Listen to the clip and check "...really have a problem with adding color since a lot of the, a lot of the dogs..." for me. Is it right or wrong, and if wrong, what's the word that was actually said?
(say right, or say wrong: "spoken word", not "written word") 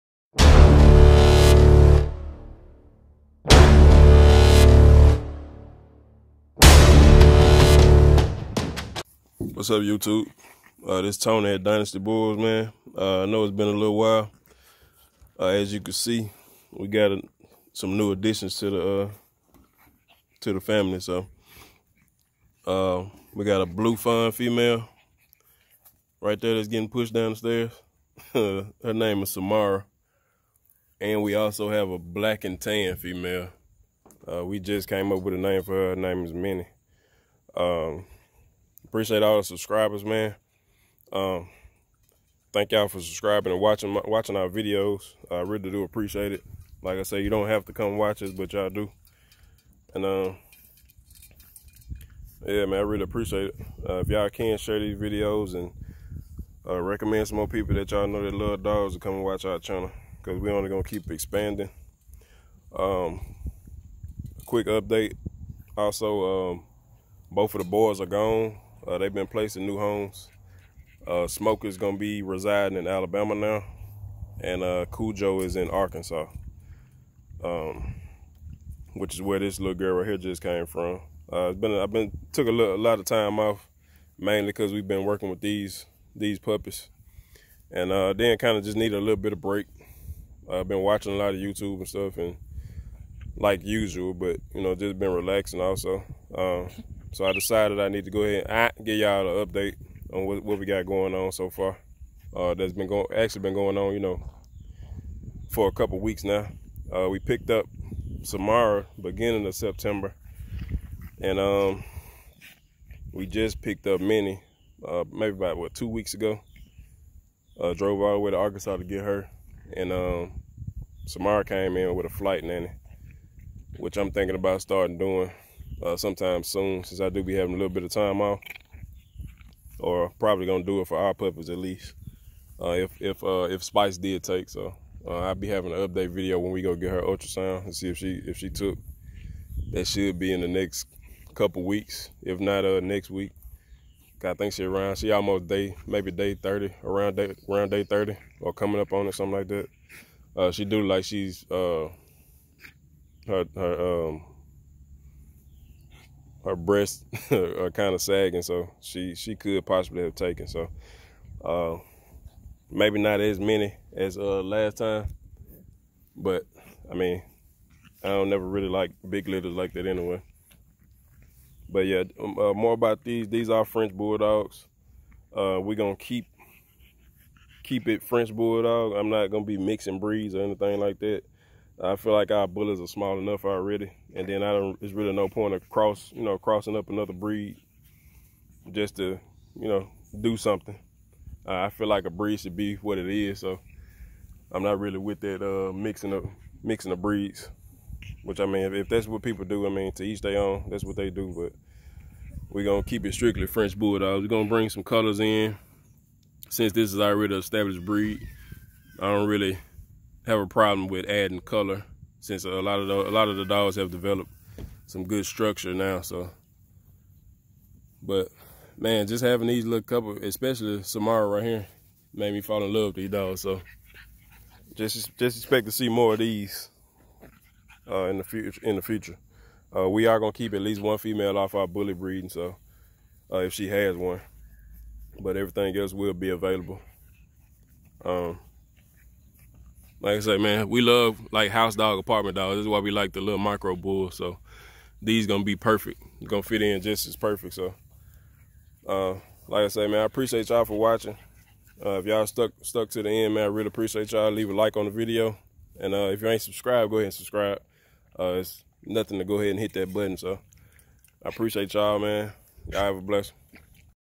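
right.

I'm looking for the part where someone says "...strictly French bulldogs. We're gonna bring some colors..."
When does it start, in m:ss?
3:23.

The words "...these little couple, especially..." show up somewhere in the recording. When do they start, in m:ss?
3:39.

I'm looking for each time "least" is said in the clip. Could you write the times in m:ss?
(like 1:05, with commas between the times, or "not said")
2:11, 3:50.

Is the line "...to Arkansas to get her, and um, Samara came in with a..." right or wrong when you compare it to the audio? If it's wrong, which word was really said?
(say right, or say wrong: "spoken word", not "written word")
right.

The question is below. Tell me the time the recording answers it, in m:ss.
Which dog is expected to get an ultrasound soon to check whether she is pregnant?
2:13.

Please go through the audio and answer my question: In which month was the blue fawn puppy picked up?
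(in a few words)
September.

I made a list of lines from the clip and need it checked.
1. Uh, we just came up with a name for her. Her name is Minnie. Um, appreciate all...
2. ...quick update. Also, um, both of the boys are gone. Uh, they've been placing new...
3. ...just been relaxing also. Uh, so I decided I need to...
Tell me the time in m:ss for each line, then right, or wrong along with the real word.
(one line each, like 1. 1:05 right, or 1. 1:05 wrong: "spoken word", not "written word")
1. 0:34 right
2. 1:04 right
3. 1:34 right.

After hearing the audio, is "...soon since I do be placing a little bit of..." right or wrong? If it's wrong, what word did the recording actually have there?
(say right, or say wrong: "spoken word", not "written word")
wrong: "having", not "placing".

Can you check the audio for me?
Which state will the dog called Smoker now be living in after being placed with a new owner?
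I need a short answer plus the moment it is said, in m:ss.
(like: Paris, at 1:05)
Alabama, at 1:12.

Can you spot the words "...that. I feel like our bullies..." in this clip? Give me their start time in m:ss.
3:00.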